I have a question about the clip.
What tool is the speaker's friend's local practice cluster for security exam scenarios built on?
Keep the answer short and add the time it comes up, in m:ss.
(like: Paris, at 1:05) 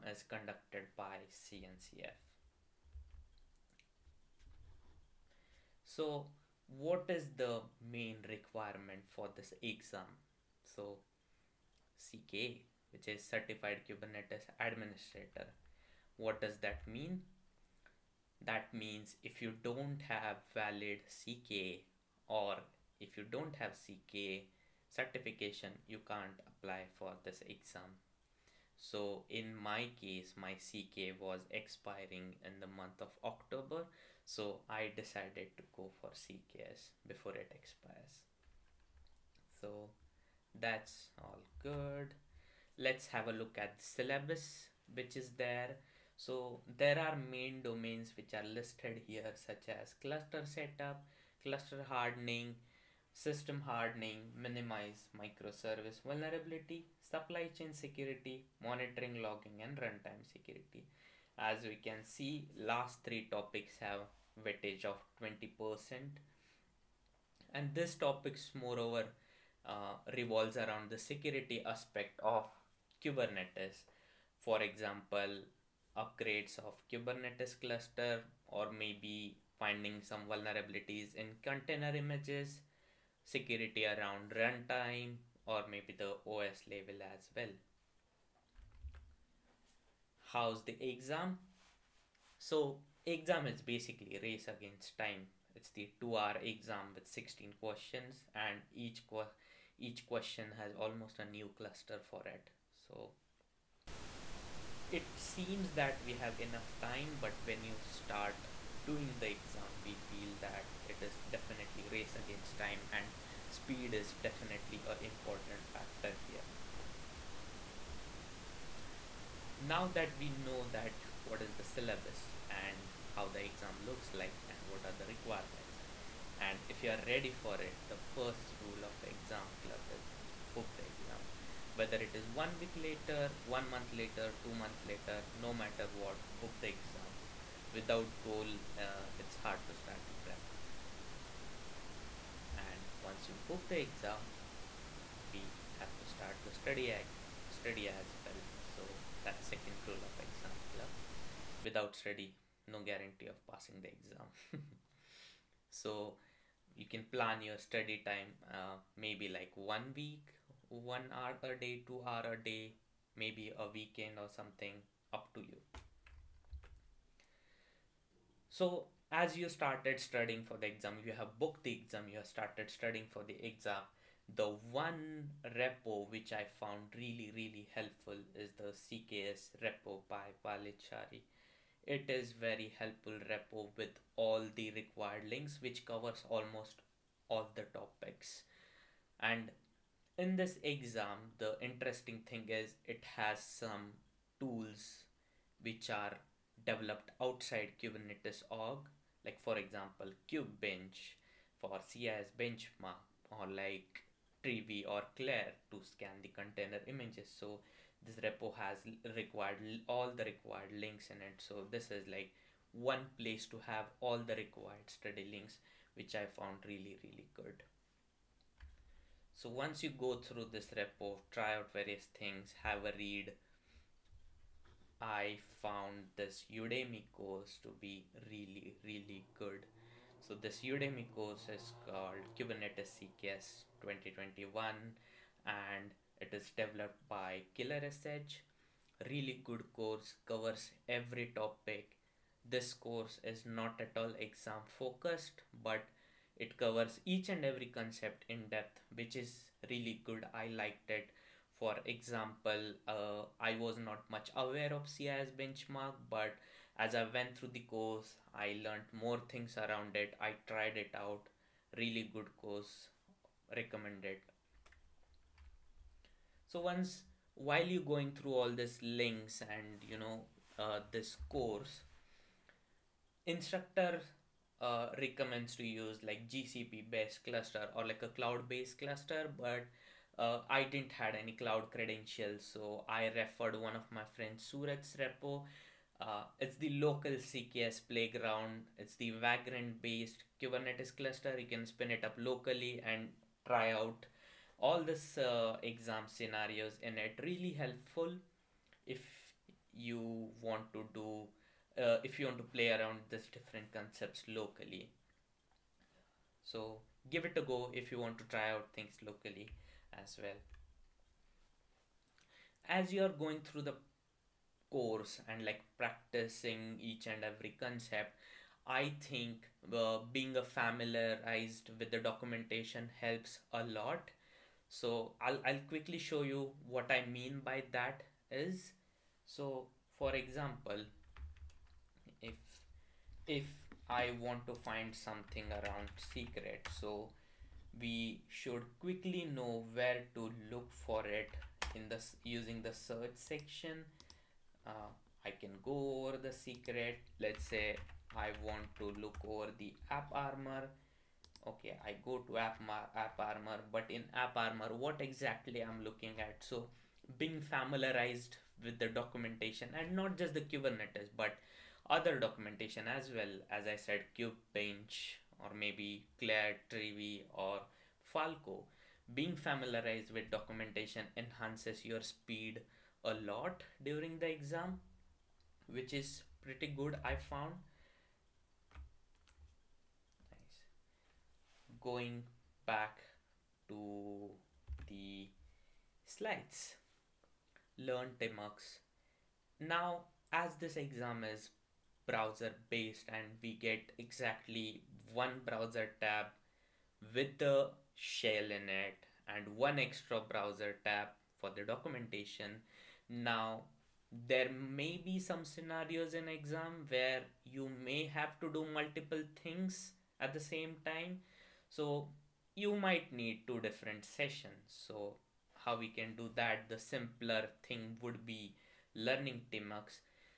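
Vagrant, at 4:49.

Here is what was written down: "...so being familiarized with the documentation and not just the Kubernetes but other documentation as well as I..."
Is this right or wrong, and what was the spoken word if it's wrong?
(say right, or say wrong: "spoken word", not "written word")
right.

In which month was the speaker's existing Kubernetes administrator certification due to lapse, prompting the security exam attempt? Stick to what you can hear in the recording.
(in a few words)
October.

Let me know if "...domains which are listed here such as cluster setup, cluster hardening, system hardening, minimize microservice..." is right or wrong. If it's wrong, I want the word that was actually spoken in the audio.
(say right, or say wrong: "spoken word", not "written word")
right.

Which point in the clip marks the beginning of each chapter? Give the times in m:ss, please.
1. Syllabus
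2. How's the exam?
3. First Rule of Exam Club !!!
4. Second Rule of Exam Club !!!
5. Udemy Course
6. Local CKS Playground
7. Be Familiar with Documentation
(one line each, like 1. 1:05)
1. 0:42
2. 1:29
3. 1:58
4. 2:23
5. 3:43
6. 4:32
7. 5:11.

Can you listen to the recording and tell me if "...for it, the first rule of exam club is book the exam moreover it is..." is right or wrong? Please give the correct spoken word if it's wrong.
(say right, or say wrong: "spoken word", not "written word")
wrong: "whether", not "moreover".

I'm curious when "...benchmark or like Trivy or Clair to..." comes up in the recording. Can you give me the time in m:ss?
3:22.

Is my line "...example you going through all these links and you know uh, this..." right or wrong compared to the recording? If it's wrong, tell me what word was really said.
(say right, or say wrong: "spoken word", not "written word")
wrong: "while", not "example".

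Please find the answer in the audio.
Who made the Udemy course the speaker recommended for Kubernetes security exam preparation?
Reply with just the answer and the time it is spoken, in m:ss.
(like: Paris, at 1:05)
Killer.sh, at 3:57.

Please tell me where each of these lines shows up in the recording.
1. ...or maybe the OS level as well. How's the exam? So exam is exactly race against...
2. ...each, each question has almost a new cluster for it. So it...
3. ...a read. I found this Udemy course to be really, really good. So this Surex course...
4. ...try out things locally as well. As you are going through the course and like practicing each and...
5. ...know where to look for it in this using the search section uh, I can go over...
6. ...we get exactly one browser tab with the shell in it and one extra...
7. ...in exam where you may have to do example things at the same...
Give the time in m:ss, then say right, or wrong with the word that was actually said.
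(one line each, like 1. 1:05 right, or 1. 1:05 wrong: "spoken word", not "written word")
1. 1:25 wrong: "basically", not "exactly"
2. 1:38 right
3. 3:42 wrong: "Udemy", not "Surex"
4. 5:08 right
5. 5:39 right
6. 6:33 right
7. 6:46 wrong: "multiple", not "example".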